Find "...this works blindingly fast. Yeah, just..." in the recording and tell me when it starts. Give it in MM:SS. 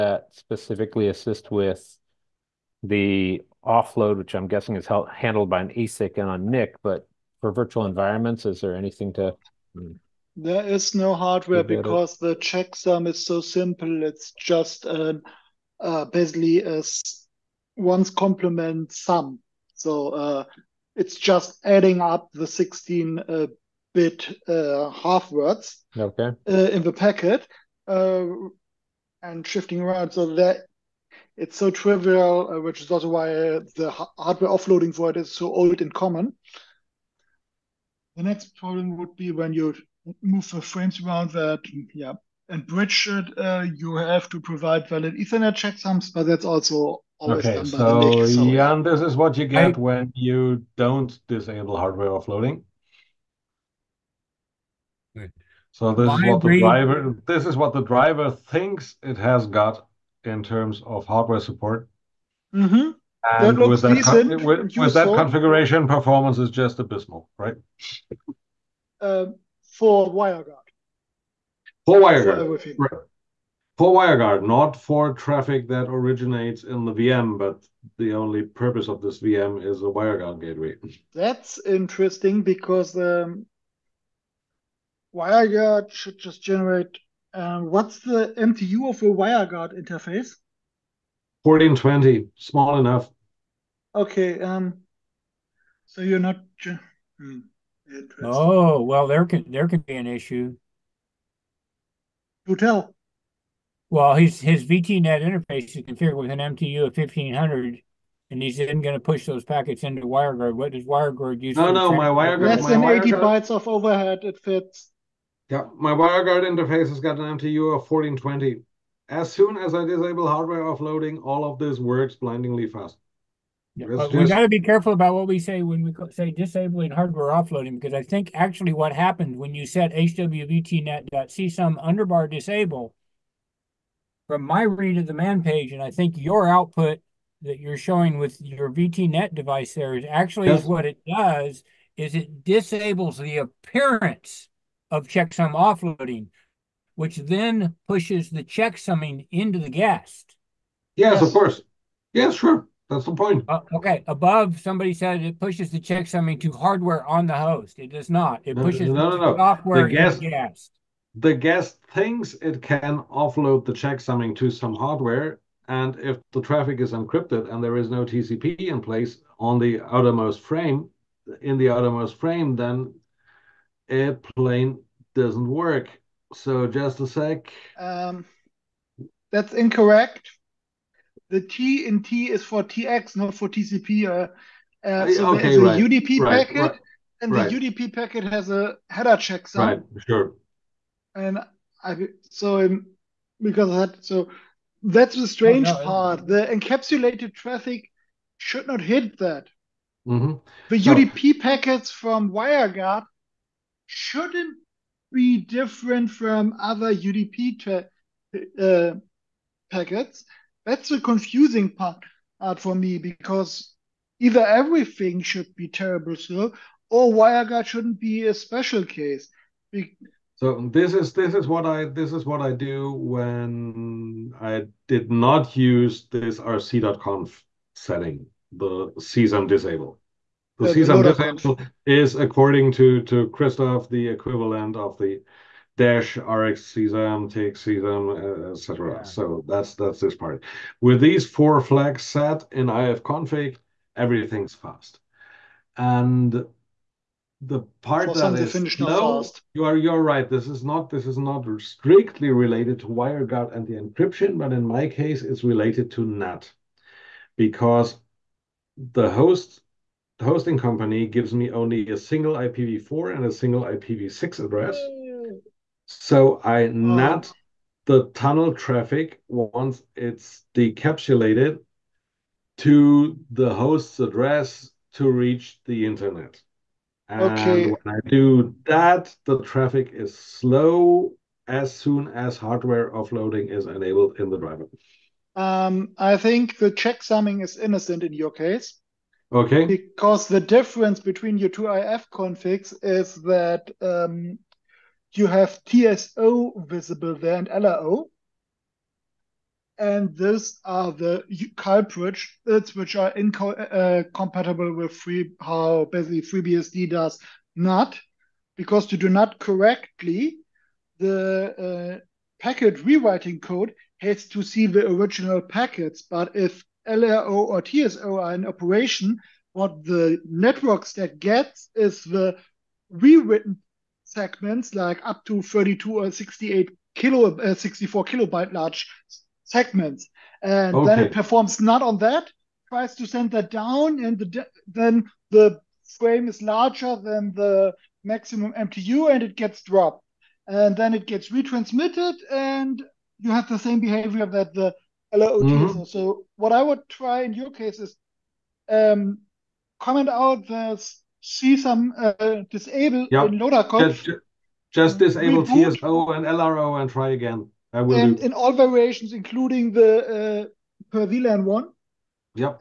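02:01.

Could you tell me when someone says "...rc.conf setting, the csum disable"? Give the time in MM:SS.
03:46.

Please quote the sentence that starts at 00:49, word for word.
when you don't disable hardware offloading.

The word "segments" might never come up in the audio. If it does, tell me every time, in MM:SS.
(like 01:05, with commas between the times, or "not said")
05:24, 05:29.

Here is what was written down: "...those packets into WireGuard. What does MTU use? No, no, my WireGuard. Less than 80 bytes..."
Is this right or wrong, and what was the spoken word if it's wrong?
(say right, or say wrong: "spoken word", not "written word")
wrong: "WireGuard", not "MTU".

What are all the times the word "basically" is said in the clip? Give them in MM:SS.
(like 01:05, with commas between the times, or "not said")
00:16, 05:05.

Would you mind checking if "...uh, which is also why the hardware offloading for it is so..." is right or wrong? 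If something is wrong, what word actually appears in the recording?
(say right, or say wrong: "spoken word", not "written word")
right.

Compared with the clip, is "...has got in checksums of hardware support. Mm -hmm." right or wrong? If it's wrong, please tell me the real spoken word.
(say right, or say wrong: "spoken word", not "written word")
wrong: "terms", not "checksums".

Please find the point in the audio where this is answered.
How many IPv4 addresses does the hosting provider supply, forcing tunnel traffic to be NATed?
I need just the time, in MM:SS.
04:21.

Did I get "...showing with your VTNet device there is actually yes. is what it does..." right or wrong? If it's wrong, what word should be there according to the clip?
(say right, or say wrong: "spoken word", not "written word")
right.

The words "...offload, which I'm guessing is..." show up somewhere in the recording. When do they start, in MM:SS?
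00:03.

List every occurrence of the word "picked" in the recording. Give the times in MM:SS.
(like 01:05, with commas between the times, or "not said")
not said.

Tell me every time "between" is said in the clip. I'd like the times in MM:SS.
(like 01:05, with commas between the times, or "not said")
04:50.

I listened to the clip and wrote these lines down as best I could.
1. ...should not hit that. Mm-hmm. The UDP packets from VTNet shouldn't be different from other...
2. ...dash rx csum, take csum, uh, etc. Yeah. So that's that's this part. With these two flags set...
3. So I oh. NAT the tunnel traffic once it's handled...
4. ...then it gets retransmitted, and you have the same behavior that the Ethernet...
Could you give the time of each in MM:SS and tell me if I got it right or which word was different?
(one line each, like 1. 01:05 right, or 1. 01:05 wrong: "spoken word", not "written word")
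1. 03:18 wrong: "WireGuard", not "VTNet"
2. 03:55 wrong: "four", not "two"
3. 04:25 wrong: "decapsulated", not "handled"
4. 05:40 wrong: "LOOT", not "Ethernet".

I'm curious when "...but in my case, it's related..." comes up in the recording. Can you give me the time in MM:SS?
04:14.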